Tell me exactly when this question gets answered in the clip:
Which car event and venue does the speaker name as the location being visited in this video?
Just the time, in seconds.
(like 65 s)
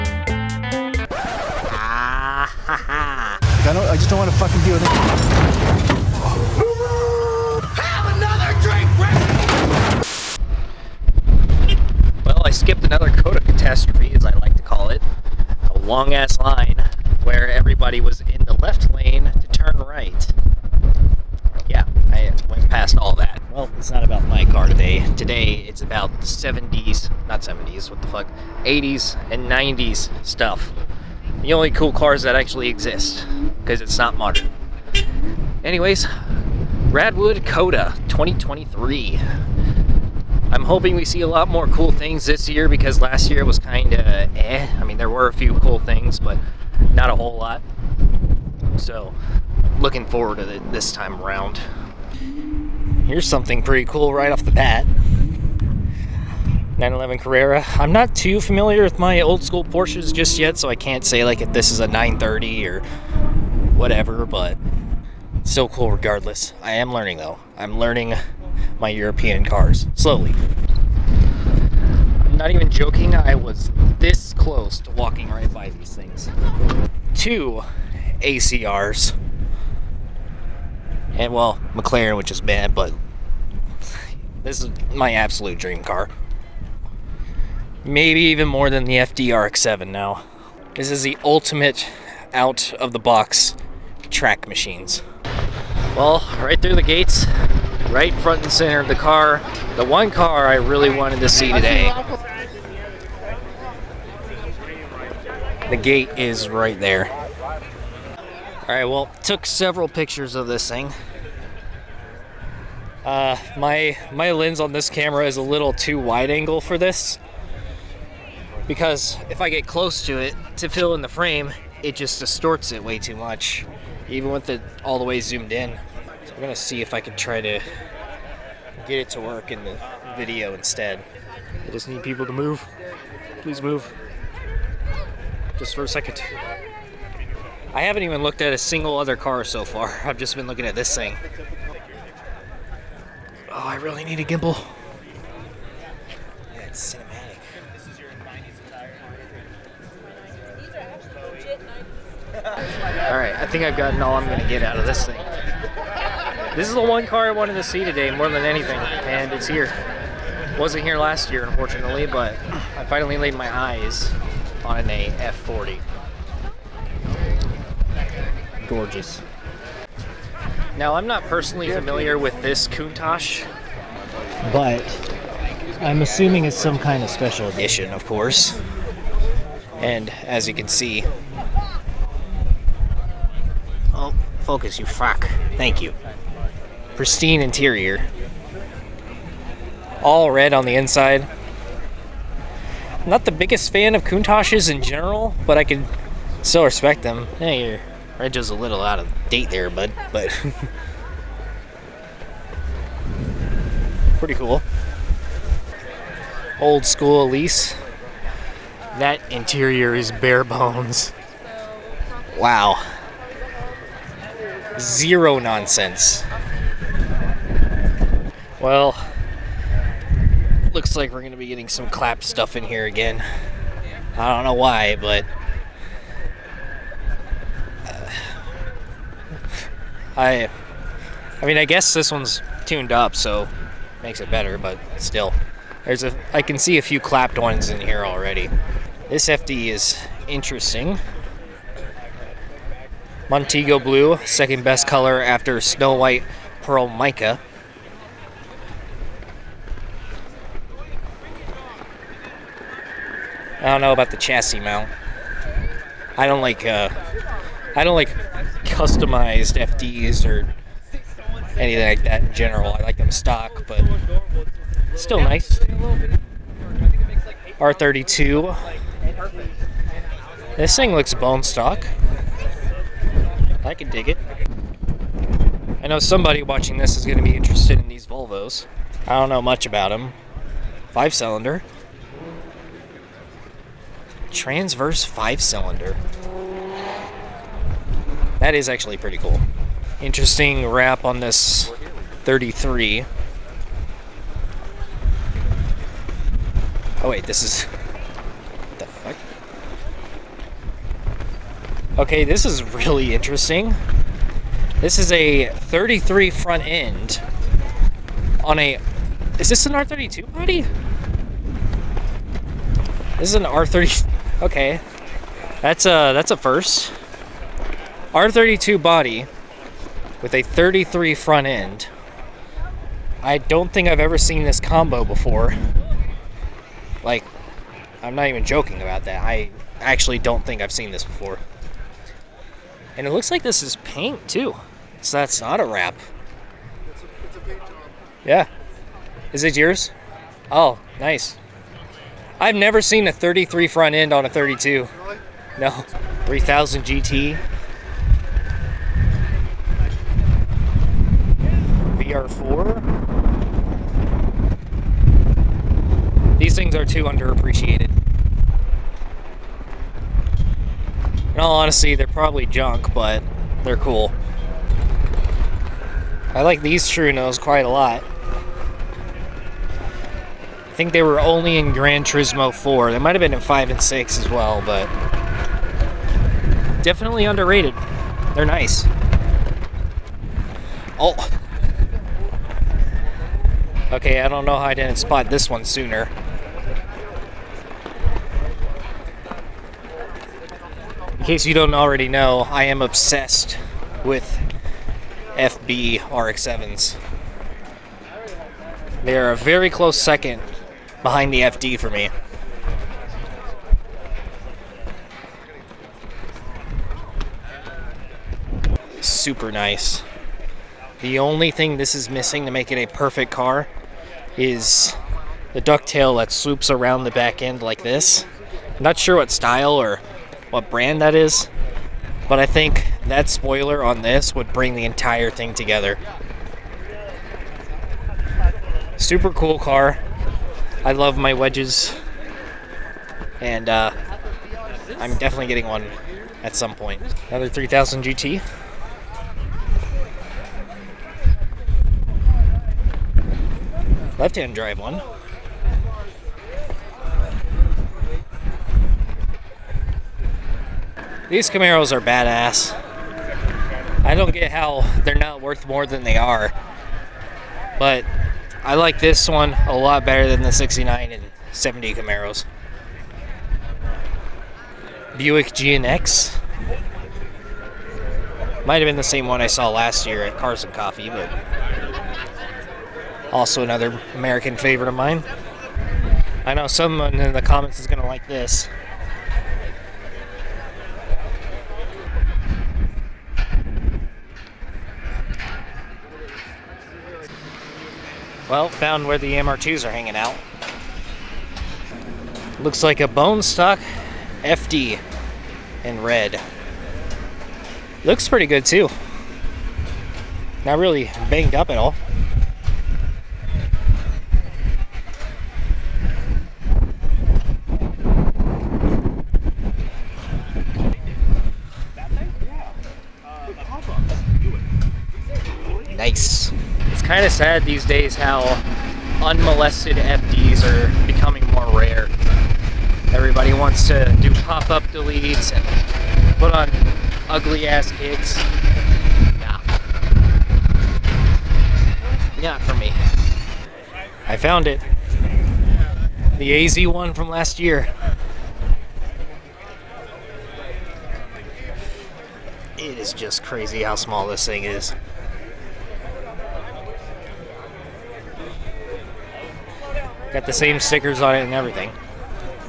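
36 s.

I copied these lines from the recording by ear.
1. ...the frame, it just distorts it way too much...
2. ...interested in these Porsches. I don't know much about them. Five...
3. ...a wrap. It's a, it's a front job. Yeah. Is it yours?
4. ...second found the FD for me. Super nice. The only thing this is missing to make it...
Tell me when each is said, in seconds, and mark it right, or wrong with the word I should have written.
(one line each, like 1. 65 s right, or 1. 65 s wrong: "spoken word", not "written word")
1. 121 s right
2. 277 s wrong: "Volvos", not "Porsches"
3. 335 s wrong: "paint", not "front"
4. 399 s wrong: "behind", not "found".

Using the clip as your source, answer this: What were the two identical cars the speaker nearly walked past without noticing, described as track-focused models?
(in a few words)
Two ACRs.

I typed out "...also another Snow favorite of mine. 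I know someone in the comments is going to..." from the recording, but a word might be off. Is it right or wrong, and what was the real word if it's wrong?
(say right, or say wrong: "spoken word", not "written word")
wrong: "American", not "Snow".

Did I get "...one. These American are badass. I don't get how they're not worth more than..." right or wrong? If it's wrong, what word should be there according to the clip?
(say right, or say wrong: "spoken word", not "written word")
wrong: "Camaros", not "American".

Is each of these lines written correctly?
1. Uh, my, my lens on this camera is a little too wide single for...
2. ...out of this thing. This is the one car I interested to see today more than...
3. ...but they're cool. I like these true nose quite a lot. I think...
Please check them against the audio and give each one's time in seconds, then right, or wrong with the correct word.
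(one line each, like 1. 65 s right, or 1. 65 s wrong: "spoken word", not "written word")
1. 113 s wrong: "angle", not "single"
2. 154 s wrong: "wanted", not "interested"
3. 362 s right.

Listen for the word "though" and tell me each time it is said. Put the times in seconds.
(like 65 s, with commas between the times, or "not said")
67 s.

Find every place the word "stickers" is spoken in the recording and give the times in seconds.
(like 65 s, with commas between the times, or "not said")
550 s.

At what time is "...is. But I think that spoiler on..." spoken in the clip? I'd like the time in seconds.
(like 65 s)
421 s.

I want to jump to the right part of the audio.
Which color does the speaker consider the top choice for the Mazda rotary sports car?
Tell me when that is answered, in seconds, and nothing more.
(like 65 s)
245 s.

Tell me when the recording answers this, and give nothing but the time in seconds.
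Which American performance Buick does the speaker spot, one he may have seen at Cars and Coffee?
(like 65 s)
465 s.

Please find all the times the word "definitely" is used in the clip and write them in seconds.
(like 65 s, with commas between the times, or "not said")
376 s, 435 s.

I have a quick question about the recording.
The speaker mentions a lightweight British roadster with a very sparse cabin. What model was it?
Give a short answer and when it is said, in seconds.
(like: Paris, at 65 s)
Elise, at 207 s.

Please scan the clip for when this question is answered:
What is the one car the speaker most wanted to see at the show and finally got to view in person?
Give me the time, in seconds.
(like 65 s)
165 s.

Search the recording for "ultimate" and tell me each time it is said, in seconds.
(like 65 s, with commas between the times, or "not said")
91 s.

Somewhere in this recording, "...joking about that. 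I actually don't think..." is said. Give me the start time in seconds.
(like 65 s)
328 s.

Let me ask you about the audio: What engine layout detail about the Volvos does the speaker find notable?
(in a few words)
Transverse five cylinder.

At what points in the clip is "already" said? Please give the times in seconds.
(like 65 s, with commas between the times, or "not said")
238 s, 391 s.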